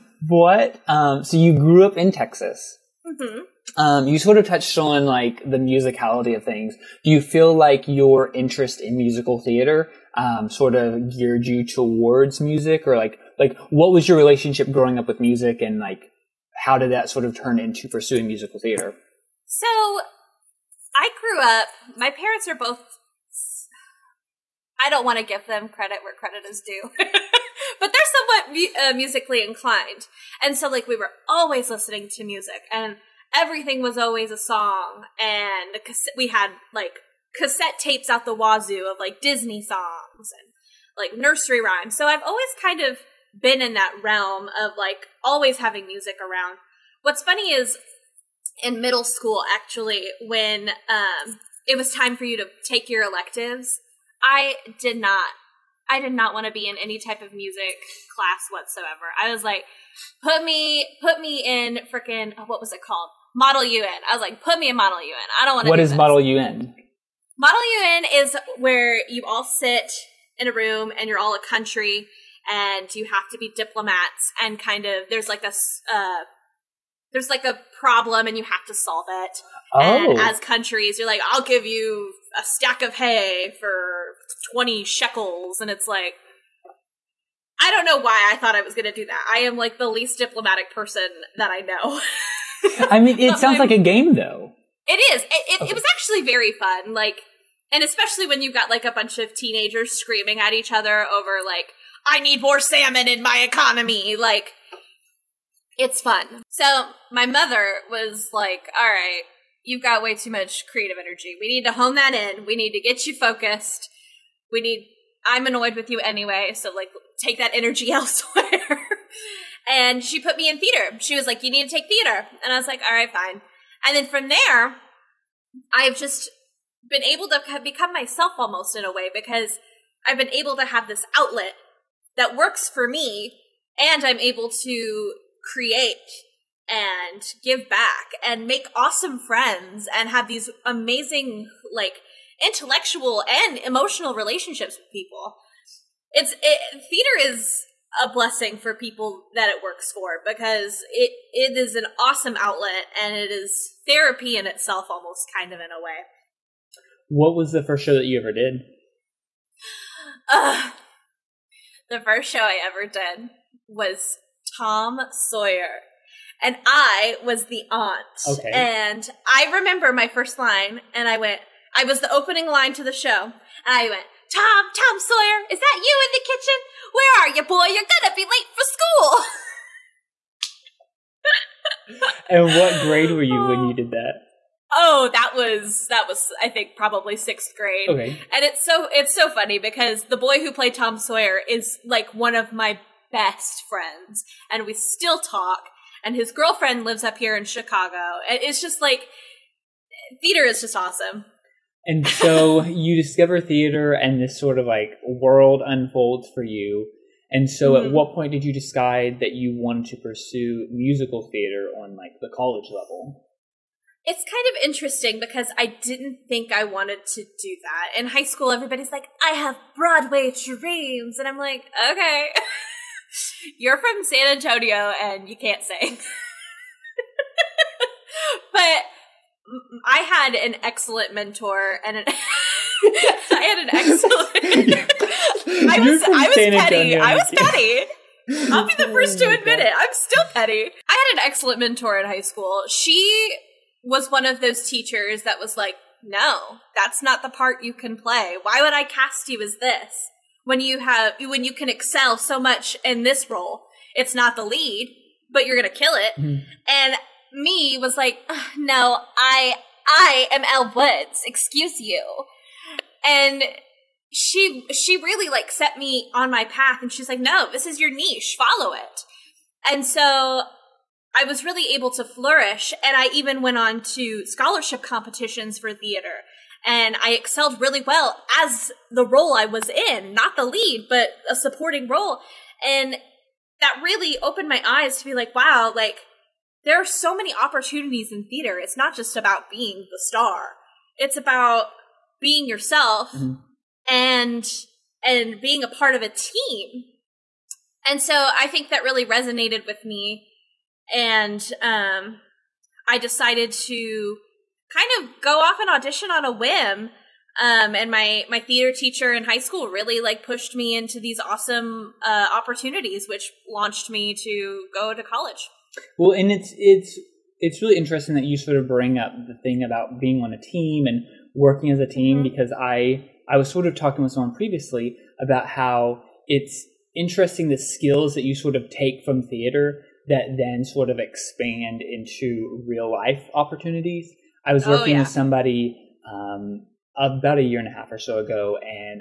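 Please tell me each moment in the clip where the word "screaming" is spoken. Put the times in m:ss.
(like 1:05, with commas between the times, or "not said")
1:39.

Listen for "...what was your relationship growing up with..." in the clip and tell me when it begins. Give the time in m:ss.
0:13.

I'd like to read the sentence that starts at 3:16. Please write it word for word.
And his girlfriend lives up here in Chicago.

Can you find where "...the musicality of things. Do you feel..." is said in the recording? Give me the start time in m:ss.
0:05.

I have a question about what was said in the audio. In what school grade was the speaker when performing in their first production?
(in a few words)
6th grade.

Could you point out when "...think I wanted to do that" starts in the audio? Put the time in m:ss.
3:36.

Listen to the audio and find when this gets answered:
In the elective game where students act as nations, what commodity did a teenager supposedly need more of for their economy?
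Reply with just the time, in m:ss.
1:42.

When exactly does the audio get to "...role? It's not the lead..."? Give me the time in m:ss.
4:13.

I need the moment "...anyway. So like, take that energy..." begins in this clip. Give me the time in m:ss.
1:56.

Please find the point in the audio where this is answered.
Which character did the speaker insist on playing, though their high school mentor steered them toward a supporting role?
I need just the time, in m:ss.
4:20.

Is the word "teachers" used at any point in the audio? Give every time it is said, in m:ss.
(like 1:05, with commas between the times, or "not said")
4:04, 5:08.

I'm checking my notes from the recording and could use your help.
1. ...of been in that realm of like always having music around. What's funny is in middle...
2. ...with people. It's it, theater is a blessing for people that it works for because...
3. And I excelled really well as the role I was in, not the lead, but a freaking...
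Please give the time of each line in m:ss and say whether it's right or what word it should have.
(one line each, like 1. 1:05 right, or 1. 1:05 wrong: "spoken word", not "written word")
1. 0:42 right
2. 2:24 right
3. 4:36 wrong: "supporting", not "freaking".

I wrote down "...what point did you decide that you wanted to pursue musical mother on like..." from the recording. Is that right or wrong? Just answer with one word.
wrong.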